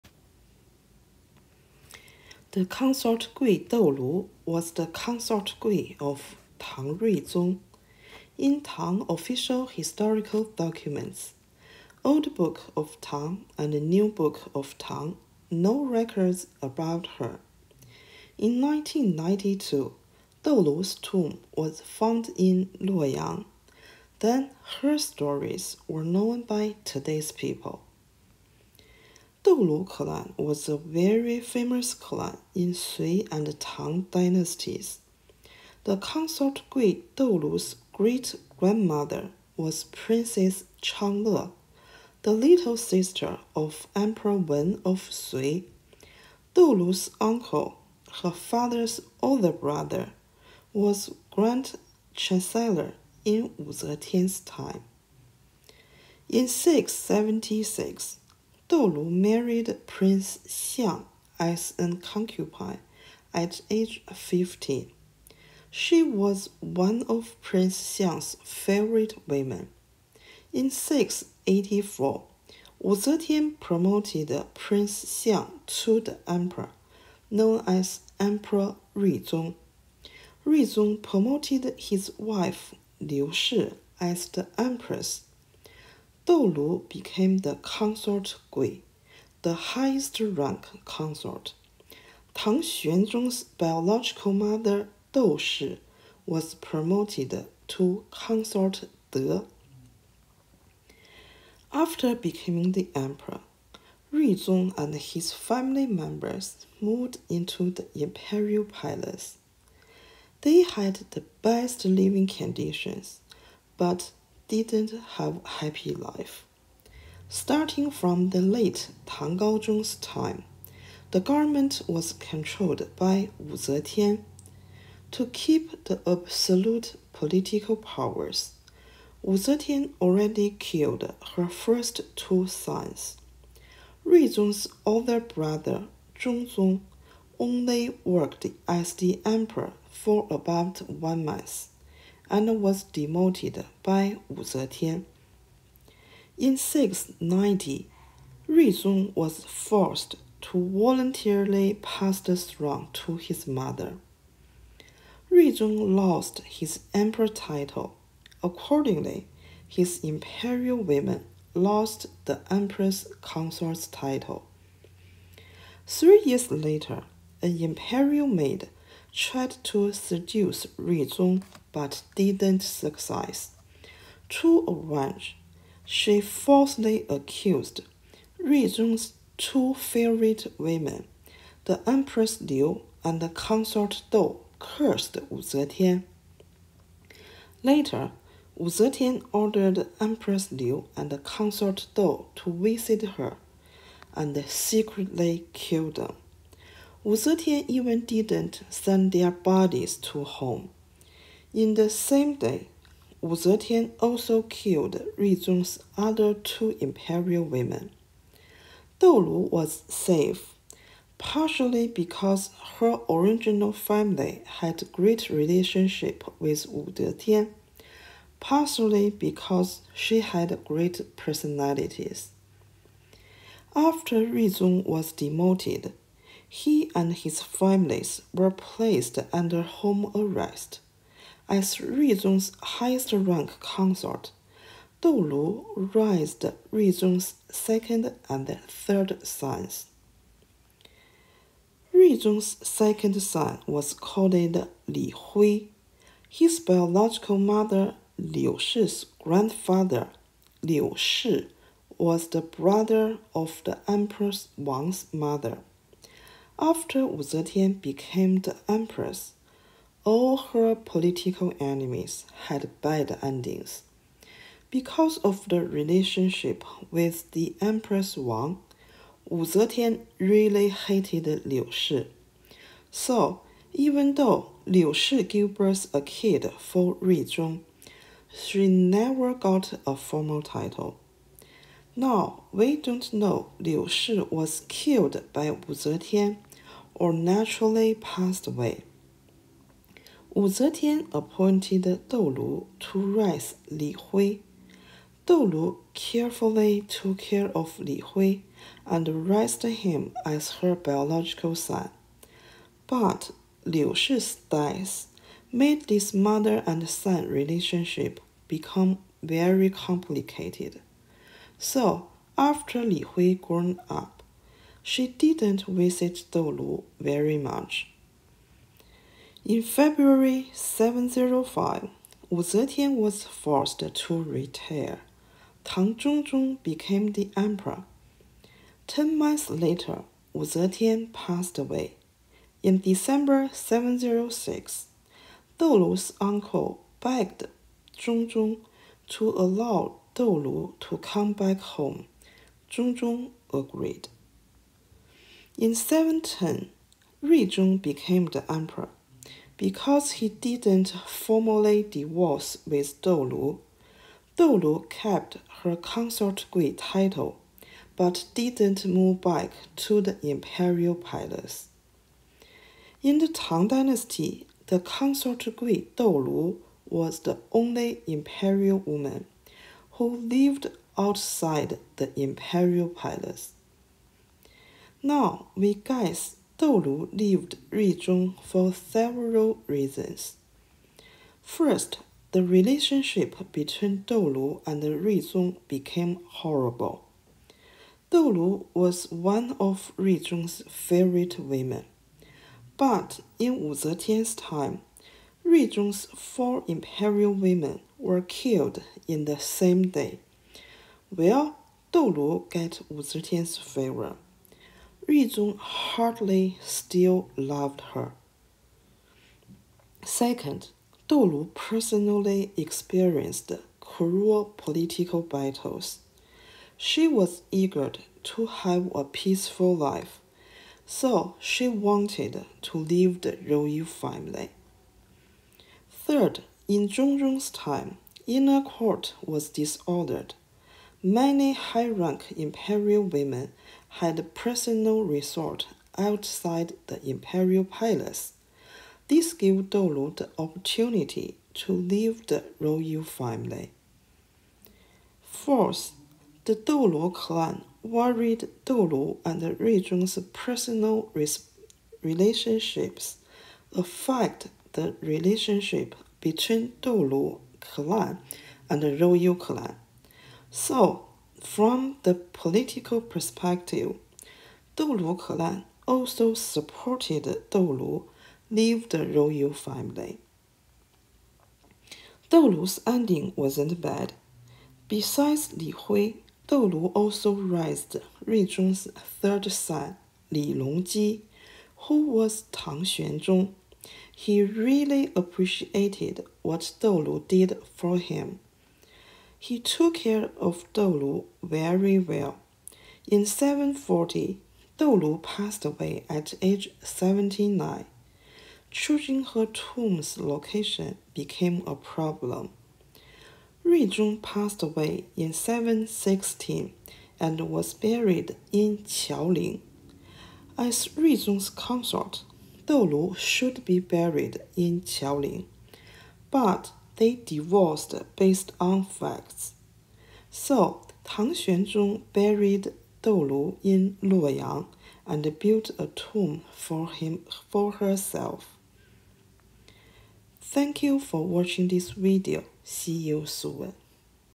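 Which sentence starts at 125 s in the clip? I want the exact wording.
To keep the absolute political powers, Wu Zetian already killed her first two sons.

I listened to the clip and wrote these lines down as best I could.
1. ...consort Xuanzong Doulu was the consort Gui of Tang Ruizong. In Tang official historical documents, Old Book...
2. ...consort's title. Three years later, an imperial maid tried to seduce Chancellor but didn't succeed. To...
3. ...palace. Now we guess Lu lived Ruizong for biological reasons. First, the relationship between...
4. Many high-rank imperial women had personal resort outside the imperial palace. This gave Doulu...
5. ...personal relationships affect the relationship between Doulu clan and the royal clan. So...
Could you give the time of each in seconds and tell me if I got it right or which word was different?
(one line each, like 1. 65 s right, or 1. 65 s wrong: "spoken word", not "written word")
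1. 2 s wrong: "Gui", not "Xuanzong"
2. 163 s wrong: "Ruizong", not "Chancellor"
3. 372 s wrong: "several", not "biological"
4. 431 s right
5. 450 s right.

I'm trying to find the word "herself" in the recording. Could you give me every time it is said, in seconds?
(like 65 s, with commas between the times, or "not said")
527 s.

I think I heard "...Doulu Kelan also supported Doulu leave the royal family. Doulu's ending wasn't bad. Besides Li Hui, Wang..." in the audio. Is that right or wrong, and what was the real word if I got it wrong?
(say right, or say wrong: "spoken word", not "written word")
wrong: "Doulu", not "Wang".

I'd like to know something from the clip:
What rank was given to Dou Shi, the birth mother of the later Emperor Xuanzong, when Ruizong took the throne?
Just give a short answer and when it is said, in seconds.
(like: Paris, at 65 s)
consort De, at 98 s.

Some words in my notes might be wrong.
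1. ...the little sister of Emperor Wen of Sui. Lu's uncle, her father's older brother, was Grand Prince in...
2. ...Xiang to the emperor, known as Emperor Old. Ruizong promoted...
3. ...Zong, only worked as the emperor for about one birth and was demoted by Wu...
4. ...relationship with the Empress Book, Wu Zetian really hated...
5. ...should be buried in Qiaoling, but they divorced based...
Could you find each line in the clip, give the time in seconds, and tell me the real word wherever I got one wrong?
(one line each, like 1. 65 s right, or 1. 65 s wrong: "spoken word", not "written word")
1. 42 s wrong: "Chancellor", not "Prince"
2. 75 s wrong: "Ruizong", not "Old"
3. 136 s wrong: "month", not "birth"
4. 265 s wrong: "Wang", not "Book"
5. 513 s right.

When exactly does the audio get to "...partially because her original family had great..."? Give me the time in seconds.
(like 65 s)
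211 s.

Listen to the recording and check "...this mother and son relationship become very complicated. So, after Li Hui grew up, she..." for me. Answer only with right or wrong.
right.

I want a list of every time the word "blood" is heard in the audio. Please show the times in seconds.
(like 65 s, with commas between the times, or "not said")
not said.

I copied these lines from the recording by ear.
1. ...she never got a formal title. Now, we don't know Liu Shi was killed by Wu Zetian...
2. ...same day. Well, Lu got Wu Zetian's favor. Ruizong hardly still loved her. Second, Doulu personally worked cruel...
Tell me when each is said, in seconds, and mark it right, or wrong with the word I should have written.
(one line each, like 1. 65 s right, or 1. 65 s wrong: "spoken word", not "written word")
1. 278 s right
2. 399 s wrong: "experienced", not "worked".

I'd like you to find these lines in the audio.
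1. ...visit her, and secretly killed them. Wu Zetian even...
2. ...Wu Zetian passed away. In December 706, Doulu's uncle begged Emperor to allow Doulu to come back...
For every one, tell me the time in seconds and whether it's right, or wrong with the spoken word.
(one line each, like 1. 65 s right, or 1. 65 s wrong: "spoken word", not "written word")
1. 192 s right
2. 330 s wrong: "Zhongzong", not "Emperor".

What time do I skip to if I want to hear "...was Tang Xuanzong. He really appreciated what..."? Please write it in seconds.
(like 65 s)
482 s.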